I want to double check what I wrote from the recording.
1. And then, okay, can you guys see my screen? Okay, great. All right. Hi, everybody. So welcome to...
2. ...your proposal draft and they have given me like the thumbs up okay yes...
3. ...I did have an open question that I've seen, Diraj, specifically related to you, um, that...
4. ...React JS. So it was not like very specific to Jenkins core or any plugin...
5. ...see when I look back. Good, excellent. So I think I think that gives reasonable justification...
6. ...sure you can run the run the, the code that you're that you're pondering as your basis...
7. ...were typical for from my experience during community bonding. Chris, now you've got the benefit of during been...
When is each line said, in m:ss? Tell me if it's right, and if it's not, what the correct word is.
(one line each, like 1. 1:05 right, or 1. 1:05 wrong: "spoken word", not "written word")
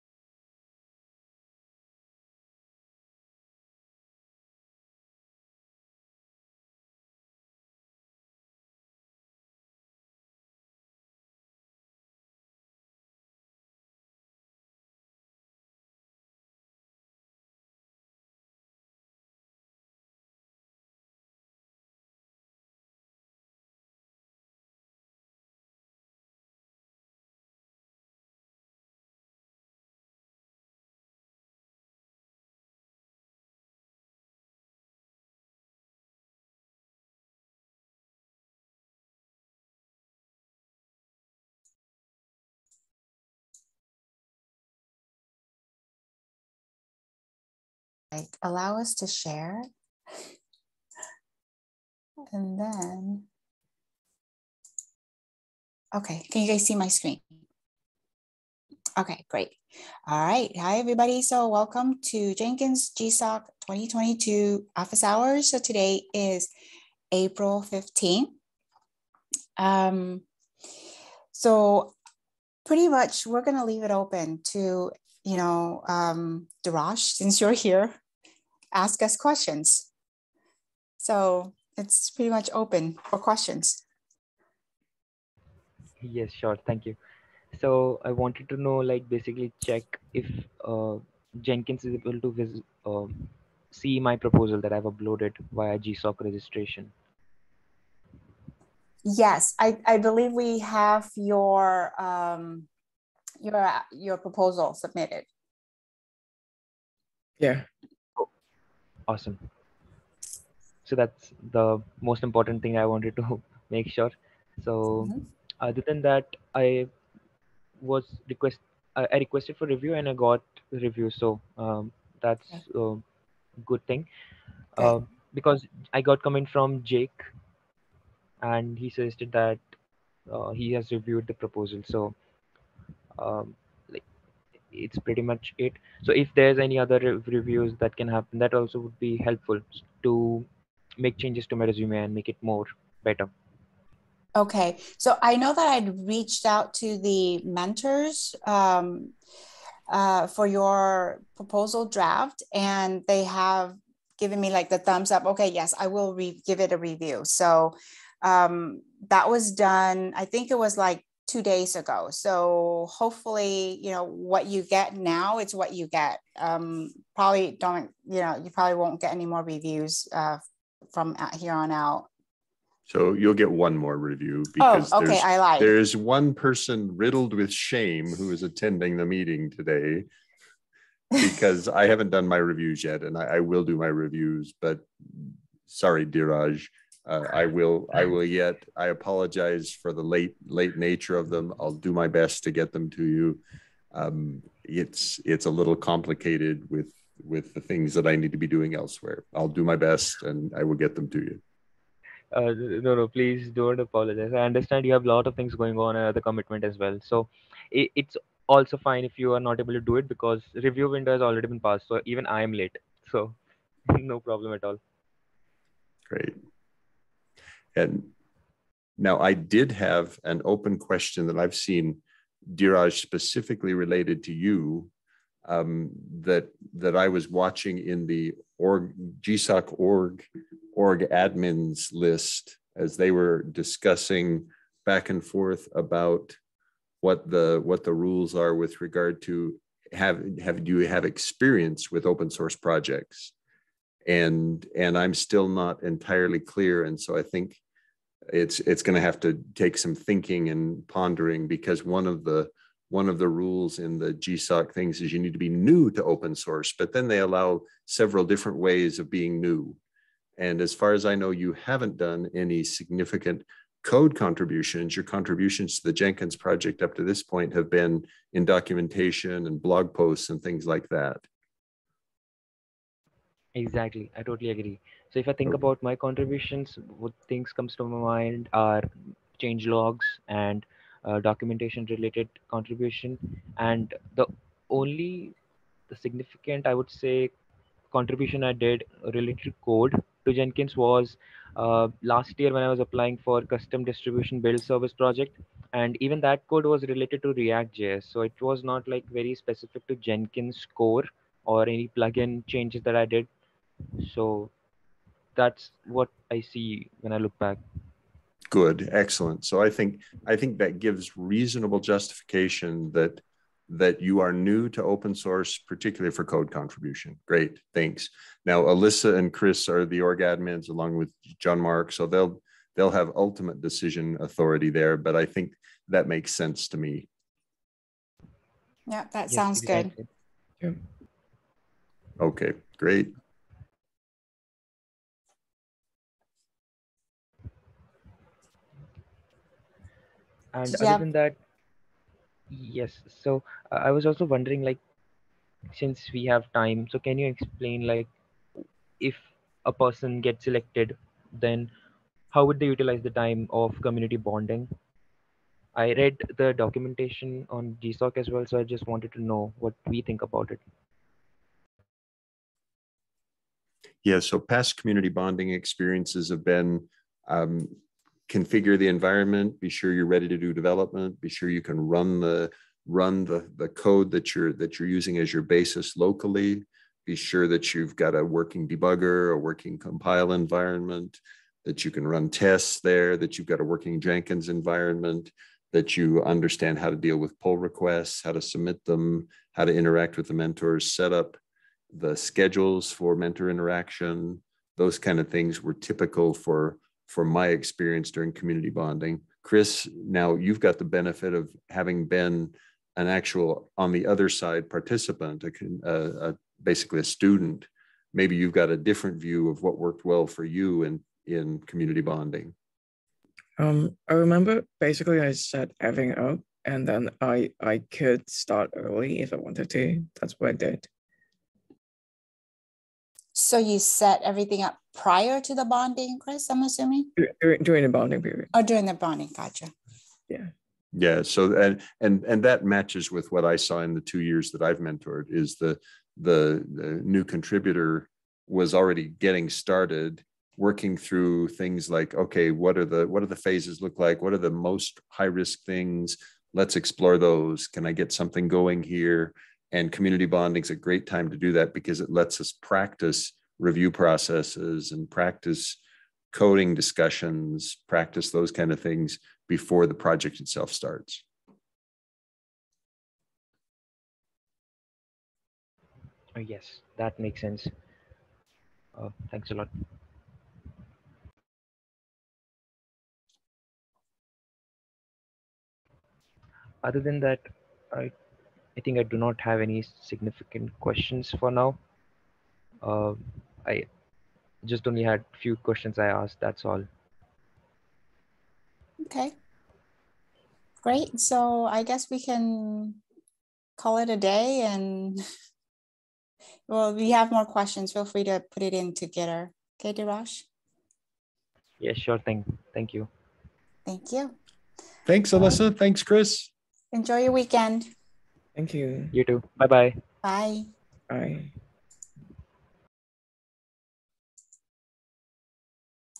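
1. 0:52 right
2. 2:30 right
3. 3:39 right
4. 4:57 right
5. 5:06 right
6. 6:11 wrong: "using", not "pondering"
7. 6:35 wrong: "having", not "during".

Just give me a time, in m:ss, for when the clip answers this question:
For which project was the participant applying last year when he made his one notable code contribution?
4:53.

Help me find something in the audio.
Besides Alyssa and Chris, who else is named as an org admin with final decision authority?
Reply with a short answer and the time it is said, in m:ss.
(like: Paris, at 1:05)
John Mark, at 5:21.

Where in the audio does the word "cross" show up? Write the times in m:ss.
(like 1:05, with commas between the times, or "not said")
not said.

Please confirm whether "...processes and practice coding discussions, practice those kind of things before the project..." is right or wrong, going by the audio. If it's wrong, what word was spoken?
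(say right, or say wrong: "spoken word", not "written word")
right.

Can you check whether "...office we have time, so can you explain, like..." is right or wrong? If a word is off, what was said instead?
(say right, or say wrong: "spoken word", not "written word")
wrong: "since", not "office".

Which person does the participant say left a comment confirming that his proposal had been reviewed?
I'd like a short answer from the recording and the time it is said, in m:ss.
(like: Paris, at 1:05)
Jake, at 2:06.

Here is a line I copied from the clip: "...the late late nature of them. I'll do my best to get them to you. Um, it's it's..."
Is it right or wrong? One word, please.
right.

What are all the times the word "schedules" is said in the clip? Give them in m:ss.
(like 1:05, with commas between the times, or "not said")
6:32.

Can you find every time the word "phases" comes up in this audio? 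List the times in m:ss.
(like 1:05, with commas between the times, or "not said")
7:23.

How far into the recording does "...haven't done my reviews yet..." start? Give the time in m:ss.
3:01.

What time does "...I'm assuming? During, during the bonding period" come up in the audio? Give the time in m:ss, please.
7:06.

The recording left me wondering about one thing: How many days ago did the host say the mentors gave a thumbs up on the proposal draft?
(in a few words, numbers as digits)
2.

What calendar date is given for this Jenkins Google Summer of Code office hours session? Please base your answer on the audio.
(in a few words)
April 15th.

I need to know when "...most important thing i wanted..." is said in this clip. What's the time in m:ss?
1:52.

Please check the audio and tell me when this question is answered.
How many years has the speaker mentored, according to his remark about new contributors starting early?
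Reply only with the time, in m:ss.
7:14.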